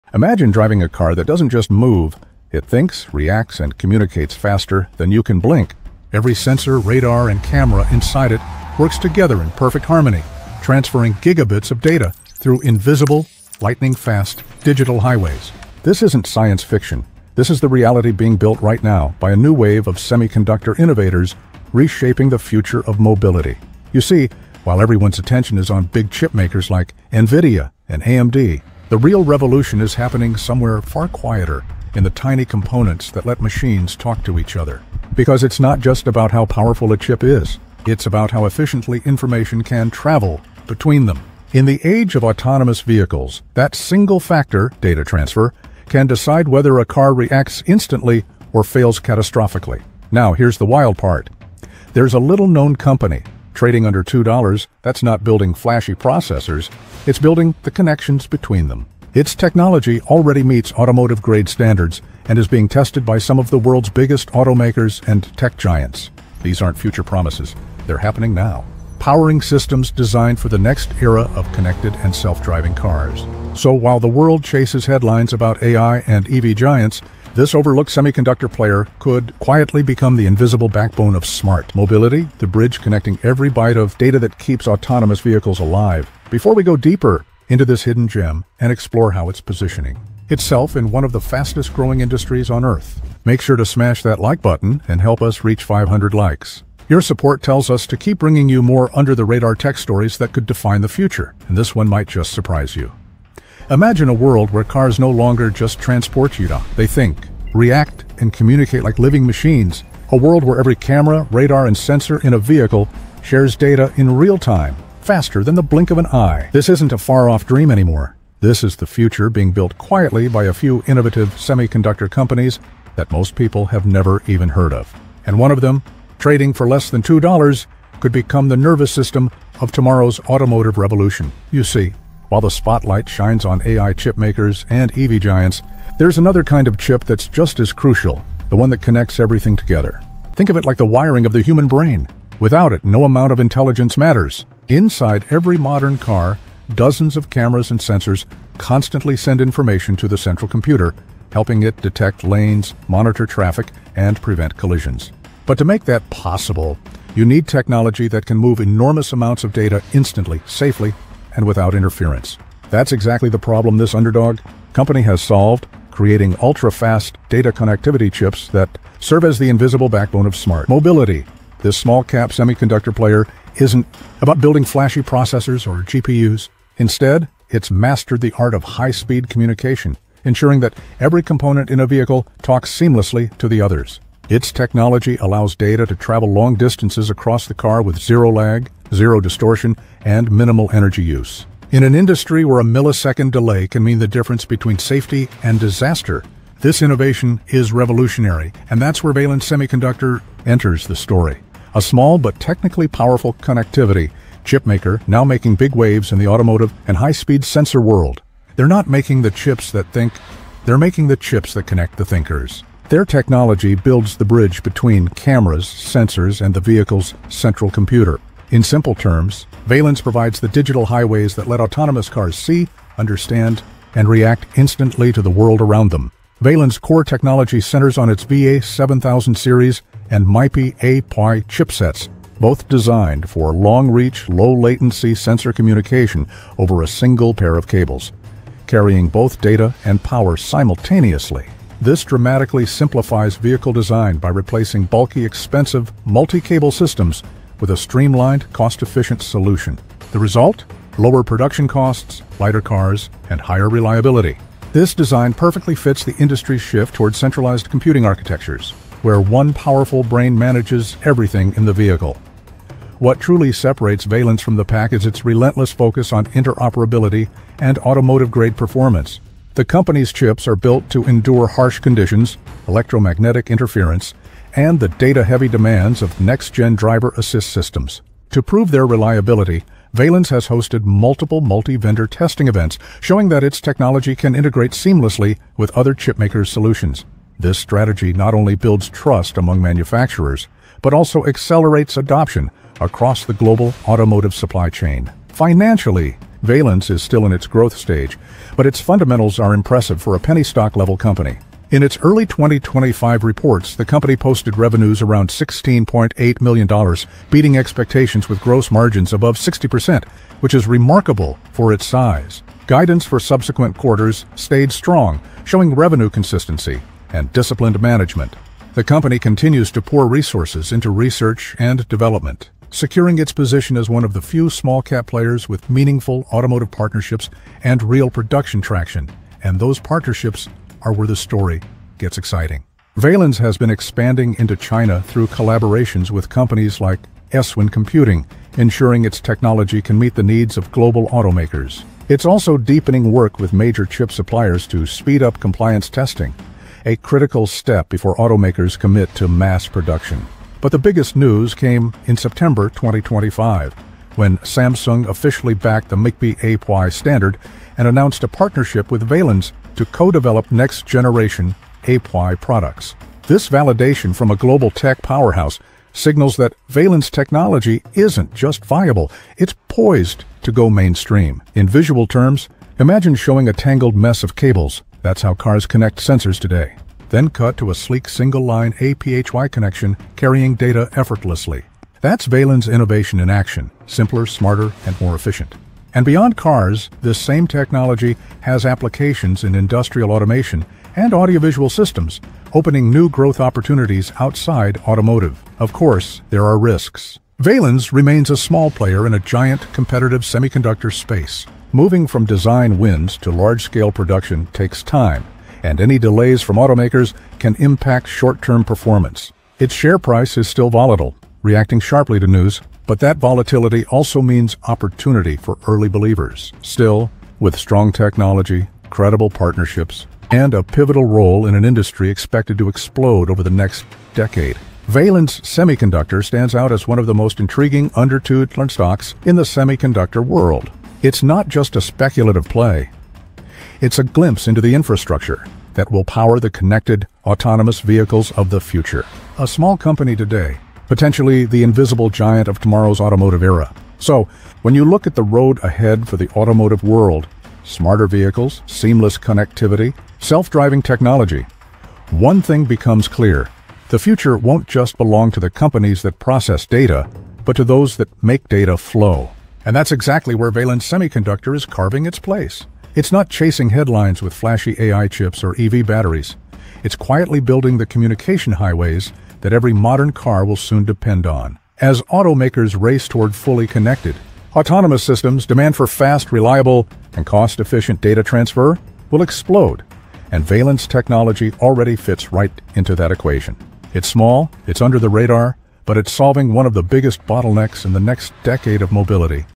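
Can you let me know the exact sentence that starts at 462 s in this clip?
It's not chasing headlines with flashy AI chips or EV batteries.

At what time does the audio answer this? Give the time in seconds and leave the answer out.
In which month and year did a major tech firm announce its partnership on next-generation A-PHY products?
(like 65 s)
352 s.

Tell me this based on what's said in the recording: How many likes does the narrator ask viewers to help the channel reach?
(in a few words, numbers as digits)
500.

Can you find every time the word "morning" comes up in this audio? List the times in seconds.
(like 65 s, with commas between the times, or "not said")
not said.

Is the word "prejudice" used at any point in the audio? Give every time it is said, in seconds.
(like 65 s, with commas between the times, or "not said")
not said.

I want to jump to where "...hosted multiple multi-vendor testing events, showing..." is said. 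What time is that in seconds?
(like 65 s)
280 s.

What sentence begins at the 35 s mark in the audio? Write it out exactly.
Because it's not just about how powerful a chip is, it's about how efficiently information can travel between them.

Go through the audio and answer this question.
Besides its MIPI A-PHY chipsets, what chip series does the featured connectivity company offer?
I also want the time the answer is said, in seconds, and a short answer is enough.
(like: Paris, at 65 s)
VA7000, at 228 s.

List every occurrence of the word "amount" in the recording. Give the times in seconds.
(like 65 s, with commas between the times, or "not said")
143 s, 159 s.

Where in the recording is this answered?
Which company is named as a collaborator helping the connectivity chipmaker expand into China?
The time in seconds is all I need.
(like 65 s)
337 s.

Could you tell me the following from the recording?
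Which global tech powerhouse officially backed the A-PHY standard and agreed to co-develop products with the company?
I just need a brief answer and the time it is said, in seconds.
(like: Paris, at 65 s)
Samsung, at 354 s.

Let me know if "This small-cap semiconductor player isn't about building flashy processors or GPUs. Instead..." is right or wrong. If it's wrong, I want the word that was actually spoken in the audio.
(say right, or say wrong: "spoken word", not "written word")
right.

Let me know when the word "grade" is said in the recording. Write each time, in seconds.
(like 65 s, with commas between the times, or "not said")
60 s, 267 s.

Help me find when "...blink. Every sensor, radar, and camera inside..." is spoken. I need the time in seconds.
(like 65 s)
5 s.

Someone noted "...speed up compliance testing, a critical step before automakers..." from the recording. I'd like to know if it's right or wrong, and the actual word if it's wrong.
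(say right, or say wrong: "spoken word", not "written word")
right.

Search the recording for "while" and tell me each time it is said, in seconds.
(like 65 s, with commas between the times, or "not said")
24 s, 73 s, 132 s.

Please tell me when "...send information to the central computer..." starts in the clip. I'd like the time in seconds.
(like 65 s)
149 s.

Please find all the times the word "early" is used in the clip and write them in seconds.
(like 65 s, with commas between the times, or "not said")
302 s, 415 s.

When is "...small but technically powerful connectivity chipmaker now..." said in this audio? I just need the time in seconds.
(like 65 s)
201 s.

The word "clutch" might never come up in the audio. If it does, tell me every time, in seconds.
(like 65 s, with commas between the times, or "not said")
not said.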